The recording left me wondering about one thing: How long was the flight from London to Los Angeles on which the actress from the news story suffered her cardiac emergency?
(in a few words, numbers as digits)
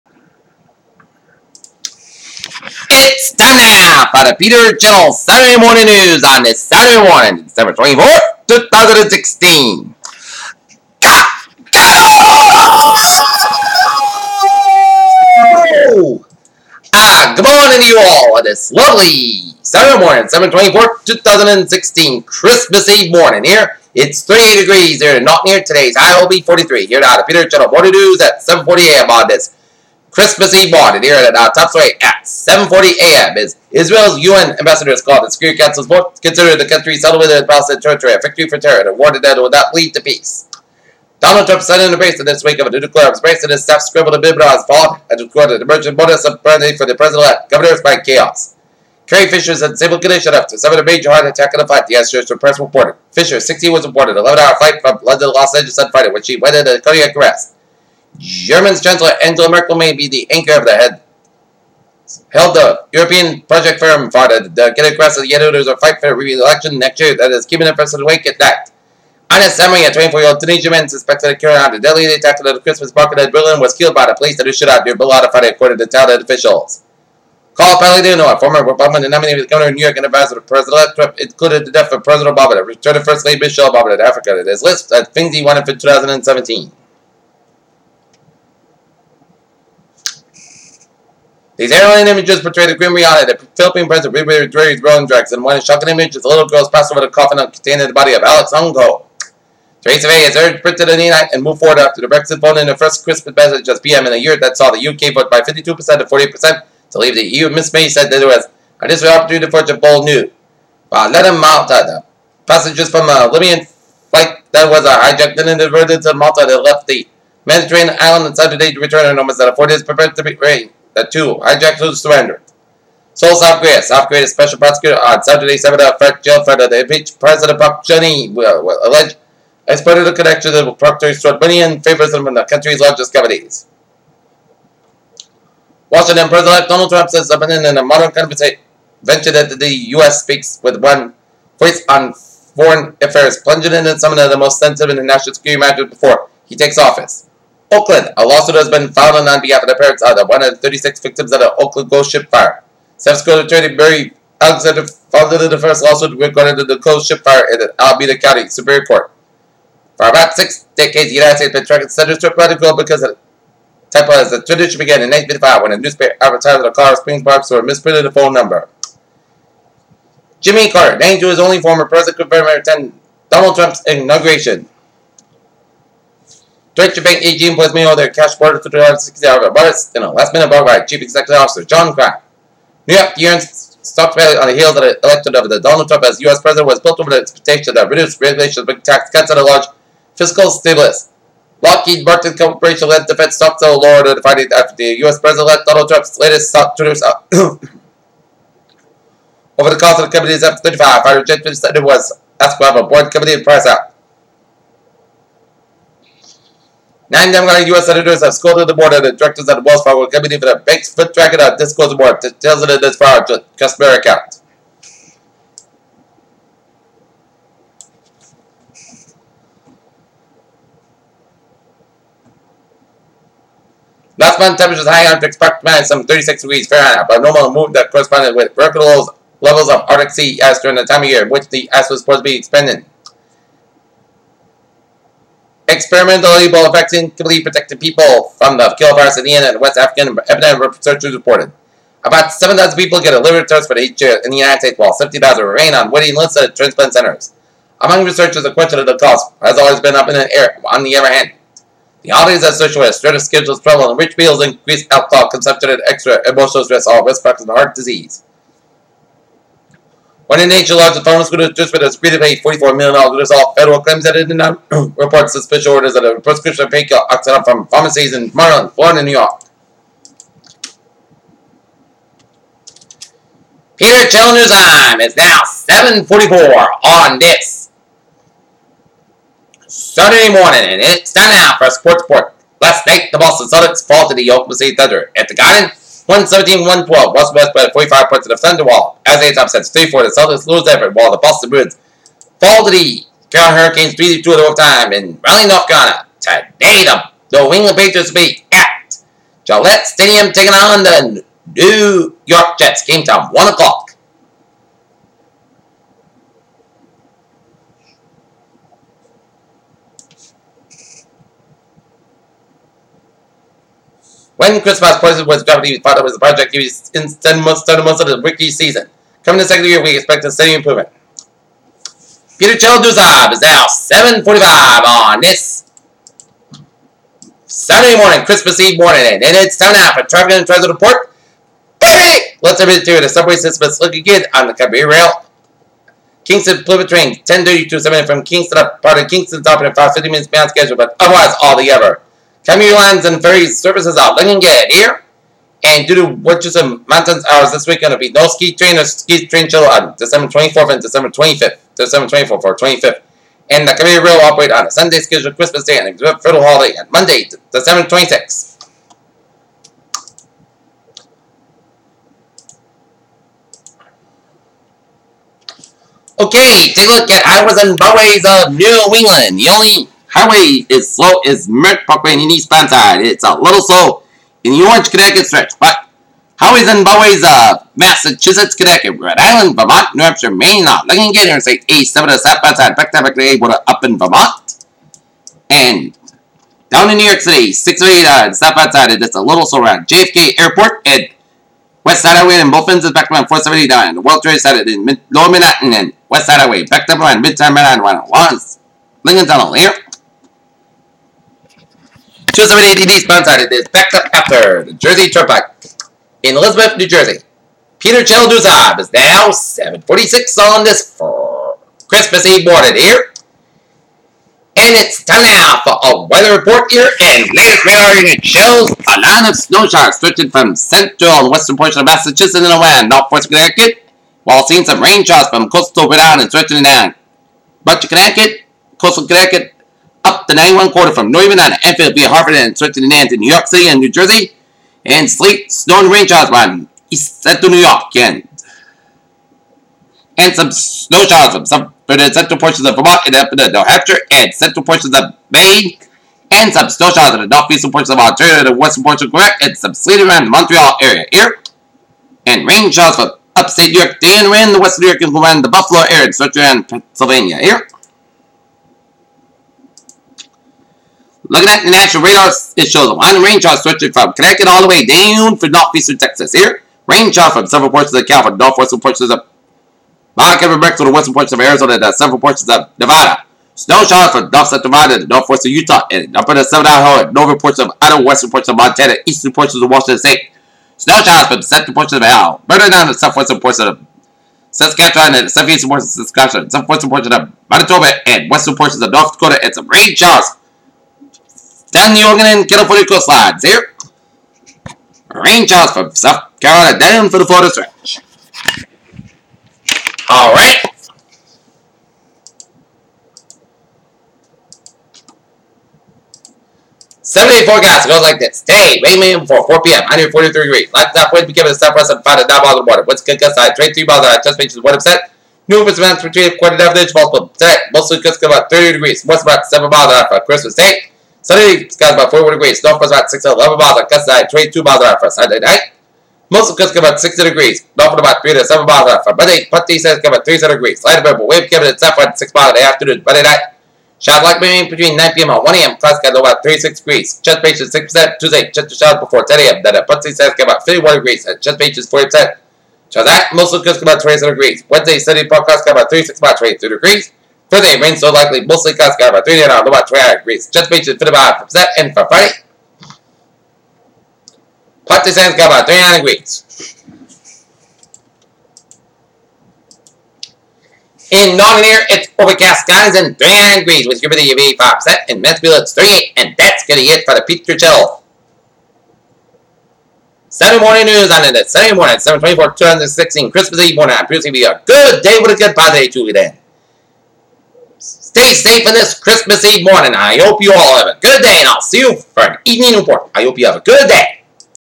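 11-hour.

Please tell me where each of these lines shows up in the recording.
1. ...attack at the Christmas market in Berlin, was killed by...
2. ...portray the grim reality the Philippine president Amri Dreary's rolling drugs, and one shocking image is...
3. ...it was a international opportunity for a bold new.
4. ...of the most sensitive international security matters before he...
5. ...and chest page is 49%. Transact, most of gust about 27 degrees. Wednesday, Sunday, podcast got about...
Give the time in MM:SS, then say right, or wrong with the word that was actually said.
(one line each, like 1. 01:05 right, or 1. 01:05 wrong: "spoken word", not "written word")
1. 01:12 right
2. 01:32 wrong: "Ribery", not "Amri"
3. 01:48 wrong: "dismal", not "international"
4. 02:24 right
5. 09:01 wrong: "40", not "49".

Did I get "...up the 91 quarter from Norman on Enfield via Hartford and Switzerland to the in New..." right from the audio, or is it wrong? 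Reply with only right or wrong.
right.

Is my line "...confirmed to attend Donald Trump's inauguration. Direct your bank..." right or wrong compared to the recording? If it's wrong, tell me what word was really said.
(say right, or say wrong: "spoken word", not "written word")
right.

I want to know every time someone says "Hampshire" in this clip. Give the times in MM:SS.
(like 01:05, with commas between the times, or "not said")
06:20, 07:23.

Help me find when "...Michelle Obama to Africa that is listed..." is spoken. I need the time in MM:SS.
01:23.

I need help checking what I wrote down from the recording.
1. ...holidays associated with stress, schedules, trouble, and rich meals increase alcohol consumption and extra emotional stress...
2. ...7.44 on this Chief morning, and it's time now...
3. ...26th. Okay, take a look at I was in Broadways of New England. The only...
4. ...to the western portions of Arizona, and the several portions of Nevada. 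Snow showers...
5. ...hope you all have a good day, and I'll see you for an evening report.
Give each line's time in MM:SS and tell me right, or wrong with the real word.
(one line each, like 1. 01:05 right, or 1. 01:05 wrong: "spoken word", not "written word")
1. 04:12 right
2. 04:35 wrong: "Sunday", not "Chief"
3. 05:57 right
4. 07:50 right
5. 09:40 right.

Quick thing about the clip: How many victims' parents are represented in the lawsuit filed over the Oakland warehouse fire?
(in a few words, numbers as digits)
136.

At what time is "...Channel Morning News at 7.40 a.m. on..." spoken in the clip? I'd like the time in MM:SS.
00:27.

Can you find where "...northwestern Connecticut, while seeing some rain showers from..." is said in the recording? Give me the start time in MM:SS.
07:02.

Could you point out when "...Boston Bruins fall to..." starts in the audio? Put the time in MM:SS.
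04:51.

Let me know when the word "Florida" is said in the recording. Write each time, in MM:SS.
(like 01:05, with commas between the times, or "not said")
04:28, 08:17.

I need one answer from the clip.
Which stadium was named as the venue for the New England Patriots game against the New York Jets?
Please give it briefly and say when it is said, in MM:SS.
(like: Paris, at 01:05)
Gillette Stadium, at 04:59.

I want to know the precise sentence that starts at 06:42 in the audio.
278 TV sponsored this backup after the Jersey Turnpike, in Elizabeth, New Jersey.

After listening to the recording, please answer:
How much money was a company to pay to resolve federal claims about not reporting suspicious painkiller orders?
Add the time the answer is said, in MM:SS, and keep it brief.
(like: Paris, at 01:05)
$44 million, at 04:22.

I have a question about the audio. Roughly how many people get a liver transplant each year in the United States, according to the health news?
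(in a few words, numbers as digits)
7,000.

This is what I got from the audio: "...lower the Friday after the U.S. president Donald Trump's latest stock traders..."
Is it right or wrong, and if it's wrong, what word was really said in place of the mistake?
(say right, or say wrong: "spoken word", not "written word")
right.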